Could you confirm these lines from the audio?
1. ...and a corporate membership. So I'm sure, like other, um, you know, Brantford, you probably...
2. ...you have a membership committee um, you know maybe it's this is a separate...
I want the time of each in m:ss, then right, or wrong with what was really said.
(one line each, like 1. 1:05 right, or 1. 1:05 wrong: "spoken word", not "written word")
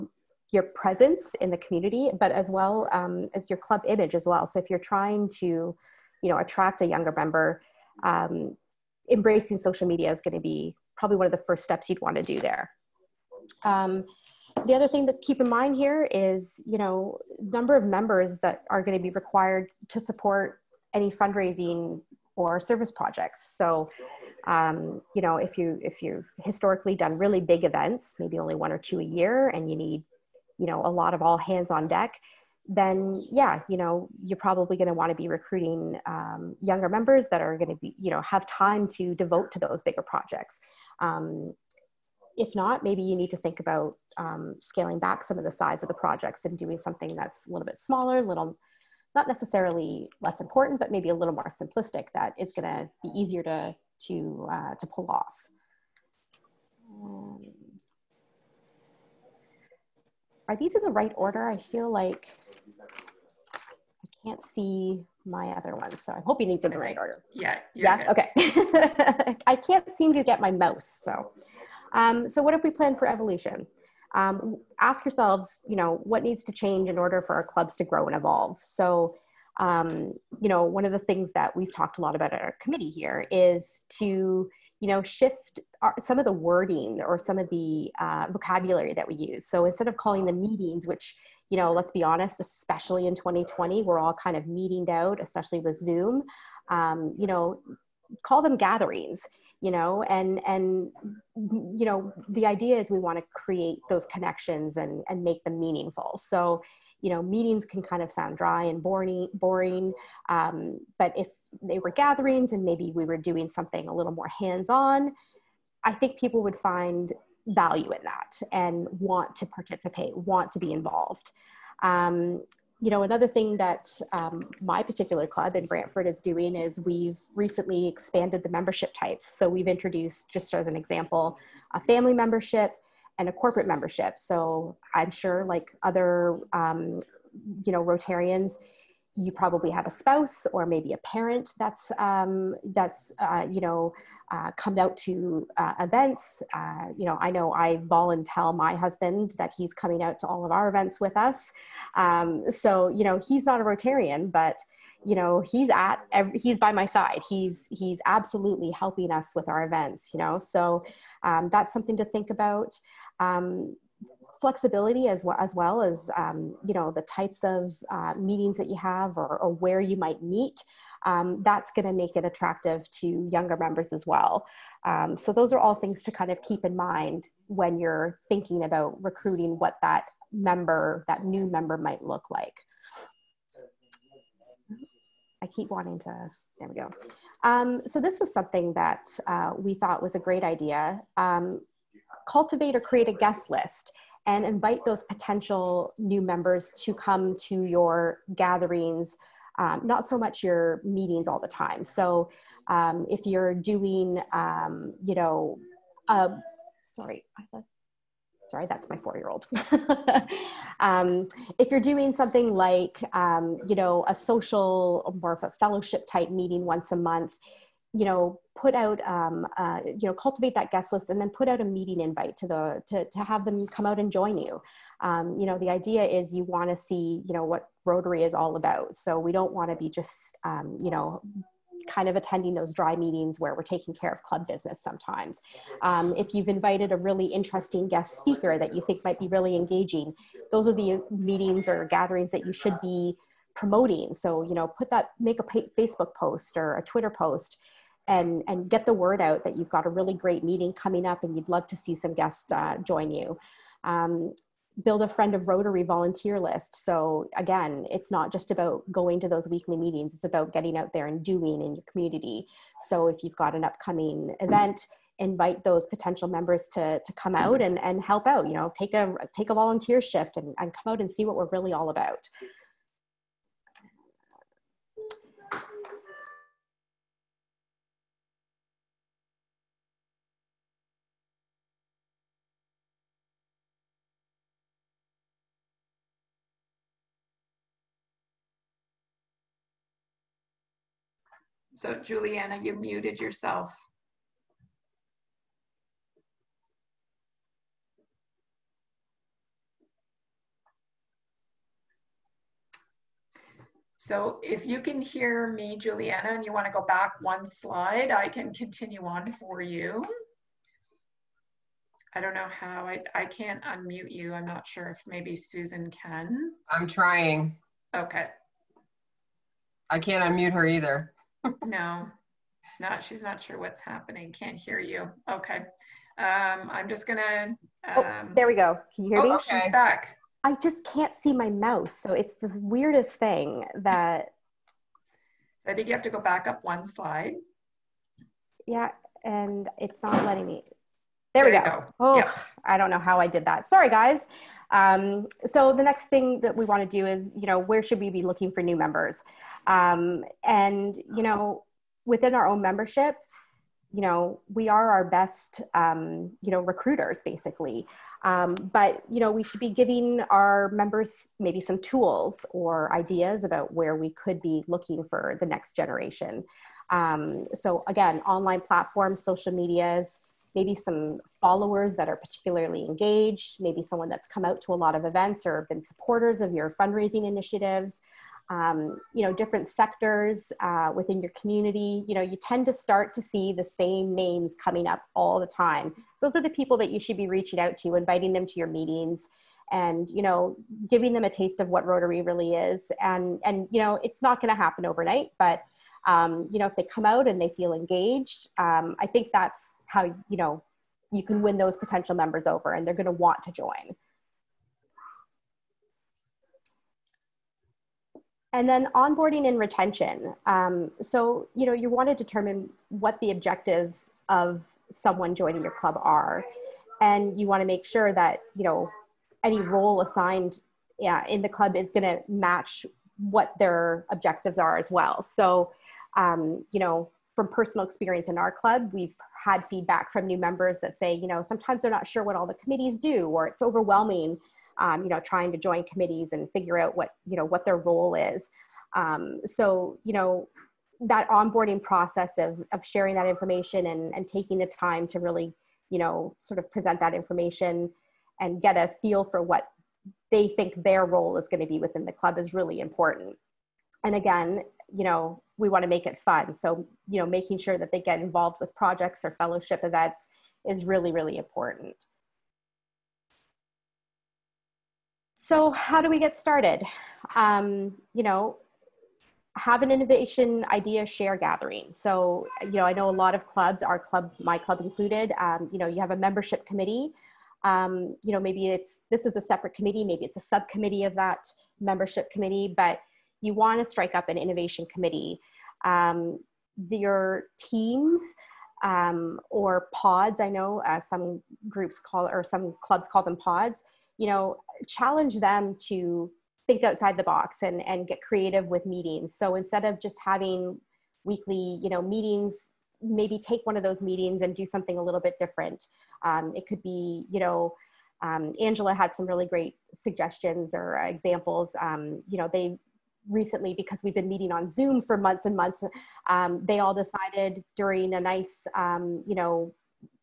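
1. 2:13 wrong: "Rotarians", not "Brantford"
2. 7:55 right.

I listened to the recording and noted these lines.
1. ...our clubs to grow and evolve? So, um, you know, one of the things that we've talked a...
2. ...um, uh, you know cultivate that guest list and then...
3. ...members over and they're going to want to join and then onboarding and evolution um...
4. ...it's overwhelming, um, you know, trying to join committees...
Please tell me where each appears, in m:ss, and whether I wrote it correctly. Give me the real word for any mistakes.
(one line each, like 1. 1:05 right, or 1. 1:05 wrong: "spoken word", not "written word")
1. 1:17 right
2. 3:39 right
3. 6:42 wrong: "retention", not "evolution"
4. 7:13 right.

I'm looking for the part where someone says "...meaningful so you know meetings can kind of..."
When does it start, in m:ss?
1:45.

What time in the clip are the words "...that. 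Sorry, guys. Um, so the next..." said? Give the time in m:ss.
5:43.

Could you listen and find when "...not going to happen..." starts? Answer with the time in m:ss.
6:34.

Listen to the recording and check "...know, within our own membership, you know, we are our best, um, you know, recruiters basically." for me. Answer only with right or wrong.
right.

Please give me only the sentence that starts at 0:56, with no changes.
Um, are these in the right order?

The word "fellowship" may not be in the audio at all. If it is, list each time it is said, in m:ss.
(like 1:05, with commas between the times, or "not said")
3:35, 7:39.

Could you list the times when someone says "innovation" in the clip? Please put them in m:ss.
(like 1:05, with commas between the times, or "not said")
7:49, 8:04.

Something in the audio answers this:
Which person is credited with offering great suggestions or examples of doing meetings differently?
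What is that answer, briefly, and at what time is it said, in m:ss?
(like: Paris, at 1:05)
Angela, at 8:28.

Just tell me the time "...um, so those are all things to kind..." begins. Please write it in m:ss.
2:54.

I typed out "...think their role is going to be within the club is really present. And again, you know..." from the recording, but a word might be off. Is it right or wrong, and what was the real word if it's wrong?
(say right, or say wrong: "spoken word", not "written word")
wrong: "important", not "present".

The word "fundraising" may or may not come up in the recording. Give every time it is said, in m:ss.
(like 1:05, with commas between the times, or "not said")
0:21, 6:16.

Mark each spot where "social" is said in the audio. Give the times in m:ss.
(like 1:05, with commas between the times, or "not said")
0:09, 3:34, 6:09.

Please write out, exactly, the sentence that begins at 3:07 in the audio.
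Um, so this was something that uh, we thought was a great idea.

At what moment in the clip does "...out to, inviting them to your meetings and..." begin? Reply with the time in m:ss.
6:27.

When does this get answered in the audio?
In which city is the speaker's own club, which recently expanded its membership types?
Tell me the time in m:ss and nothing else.
2:05.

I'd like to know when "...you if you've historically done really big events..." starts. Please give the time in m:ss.
0:25.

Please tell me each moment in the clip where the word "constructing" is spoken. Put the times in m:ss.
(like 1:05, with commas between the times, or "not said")
not said.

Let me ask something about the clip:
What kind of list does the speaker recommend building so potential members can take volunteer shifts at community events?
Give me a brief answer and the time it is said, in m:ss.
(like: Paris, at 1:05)
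friend of Rotary volunteer list, at 4:15.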